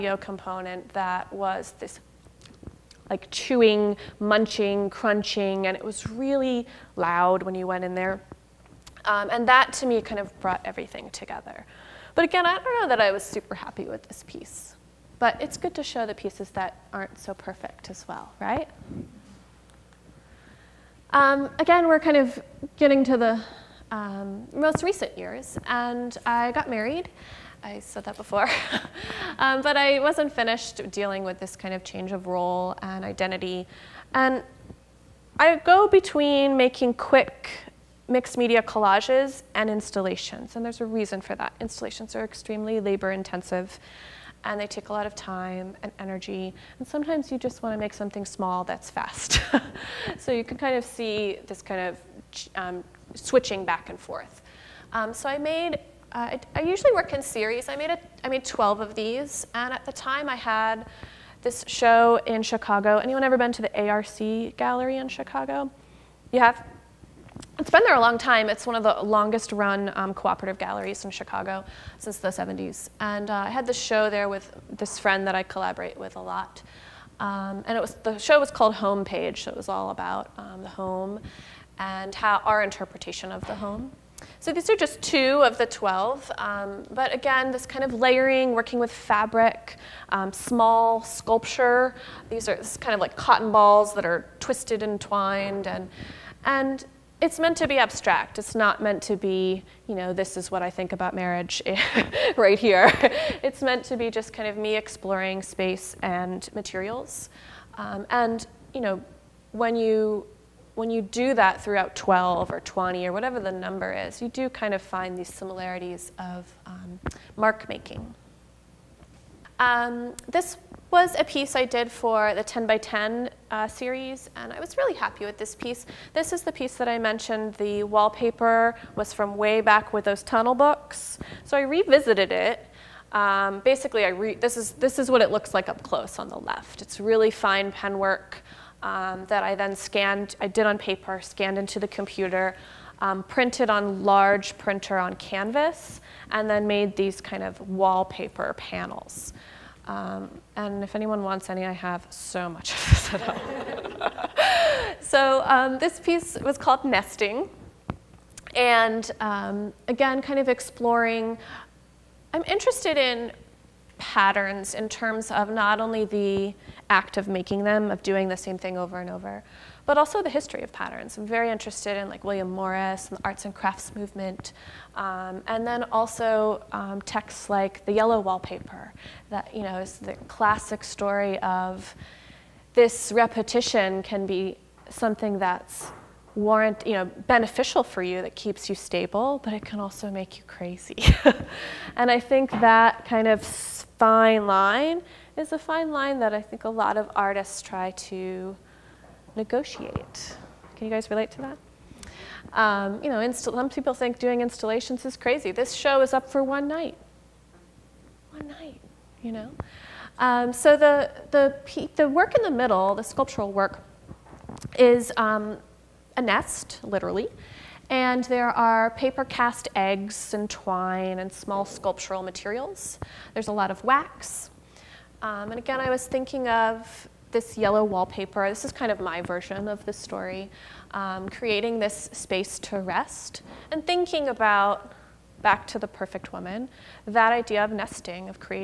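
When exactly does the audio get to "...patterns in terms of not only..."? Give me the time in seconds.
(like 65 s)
163 s.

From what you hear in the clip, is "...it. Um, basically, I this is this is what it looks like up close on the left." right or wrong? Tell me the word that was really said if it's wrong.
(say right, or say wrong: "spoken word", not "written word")
right.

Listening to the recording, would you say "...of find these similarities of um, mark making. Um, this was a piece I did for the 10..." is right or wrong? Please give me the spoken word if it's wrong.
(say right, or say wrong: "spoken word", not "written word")
right.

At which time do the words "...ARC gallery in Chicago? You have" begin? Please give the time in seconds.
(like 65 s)
63 s.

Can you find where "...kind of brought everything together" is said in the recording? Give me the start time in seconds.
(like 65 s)
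10 s.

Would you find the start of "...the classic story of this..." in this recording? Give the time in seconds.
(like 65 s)
179 s.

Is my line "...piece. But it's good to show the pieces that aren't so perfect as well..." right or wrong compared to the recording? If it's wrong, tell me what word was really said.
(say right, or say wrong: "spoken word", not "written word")
right.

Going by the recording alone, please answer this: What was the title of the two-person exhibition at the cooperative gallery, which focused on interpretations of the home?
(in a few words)
Homepage.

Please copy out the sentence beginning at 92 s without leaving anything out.
These are kind of like cotton balls that are twisted and twined.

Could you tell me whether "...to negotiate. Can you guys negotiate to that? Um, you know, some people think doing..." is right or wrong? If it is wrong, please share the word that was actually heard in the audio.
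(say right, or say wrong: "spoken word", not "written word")
wrong: "relate", not "negotiate".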